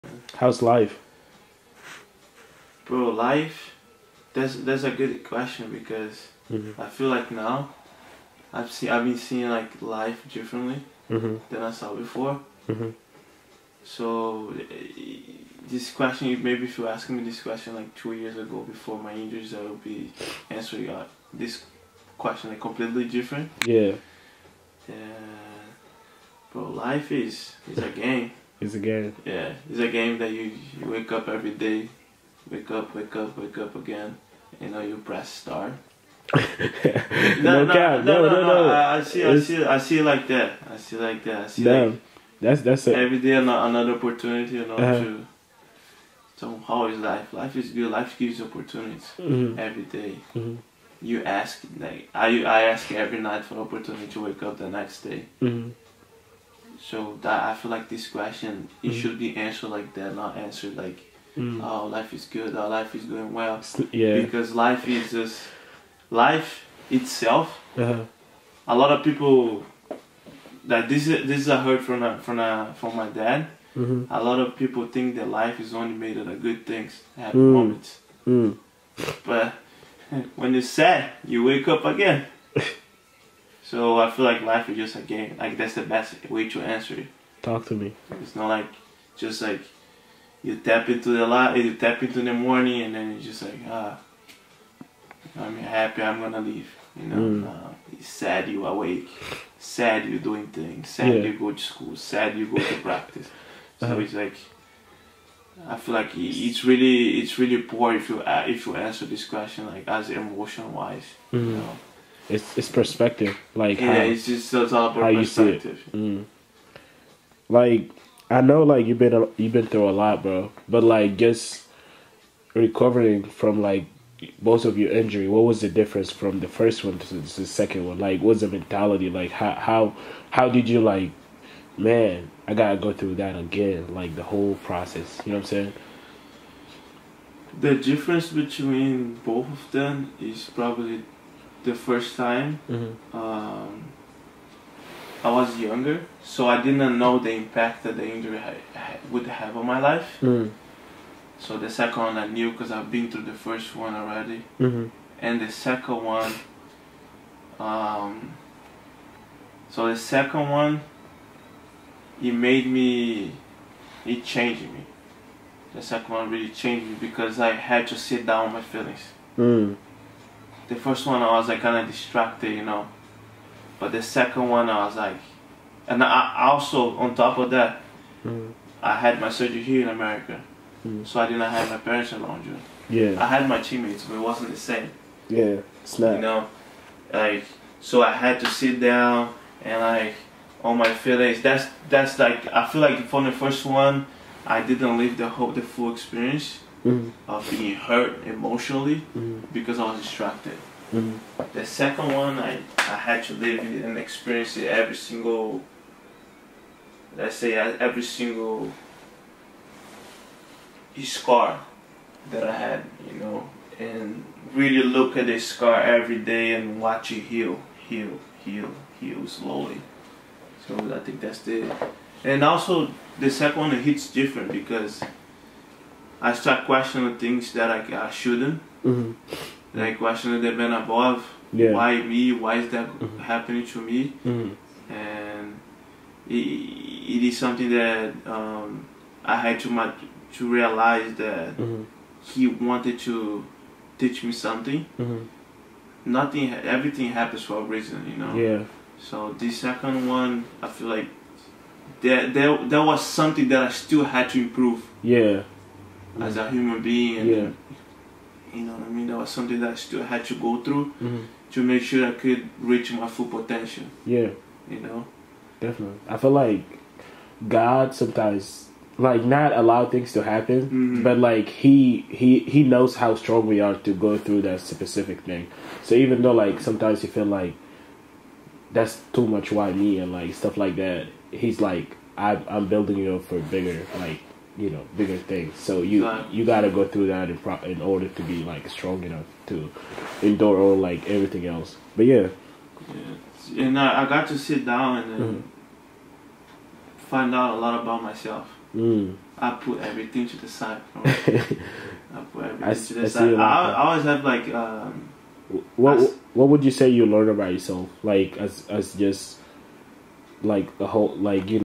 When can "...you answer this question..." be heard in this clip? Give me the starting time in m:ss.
1:48.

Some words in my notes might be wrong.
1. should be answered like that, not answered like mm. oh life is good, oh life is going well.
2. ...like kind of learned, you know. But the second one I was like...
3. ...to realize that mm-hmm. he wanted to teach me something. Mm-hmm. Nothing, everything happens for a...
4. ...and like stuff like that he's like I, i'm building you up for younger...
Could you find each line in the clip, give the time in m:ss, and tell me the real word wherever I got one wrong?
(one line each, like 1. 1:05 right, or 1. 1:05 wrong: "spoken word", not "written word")
1. 0:59 right
2. 2:51 wrong: "distracted", not "learned"
3. 4:00 right
4. 4:39 wrong: "bigger", not "younger".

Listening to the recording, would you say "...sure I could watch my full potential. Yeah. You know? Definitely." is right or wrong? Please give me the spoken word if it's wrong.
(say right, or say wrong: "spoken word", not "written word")
wrong: "reach", not "watch".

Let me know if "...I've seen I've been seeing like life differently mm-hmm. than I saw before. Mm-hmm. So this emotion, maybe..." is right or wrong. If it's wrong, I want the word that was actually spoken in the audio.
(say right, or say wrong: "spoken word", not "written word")
wrong: "question", not "emotion".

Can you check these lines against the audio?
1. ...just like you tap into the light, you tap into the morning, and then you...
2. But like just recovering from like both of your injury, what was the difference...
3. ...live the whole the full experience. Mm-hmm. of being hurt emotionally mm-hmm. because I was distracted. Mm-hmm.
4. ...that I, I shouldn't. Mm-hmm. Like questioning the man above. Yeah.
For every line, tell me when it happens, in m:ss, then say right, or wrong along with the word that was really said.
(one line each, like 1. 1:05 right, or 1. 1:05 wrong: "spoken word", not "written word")
1. 1:29 right
2. 2:00 right
3. 3:14 right
4. 3:47 right.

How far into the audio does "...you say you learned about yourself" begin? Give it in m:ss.
5:06.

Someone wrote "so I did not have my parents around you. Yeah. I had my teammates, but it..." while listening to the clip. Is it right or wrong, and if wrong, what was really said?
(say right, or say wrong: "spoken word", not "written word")
right.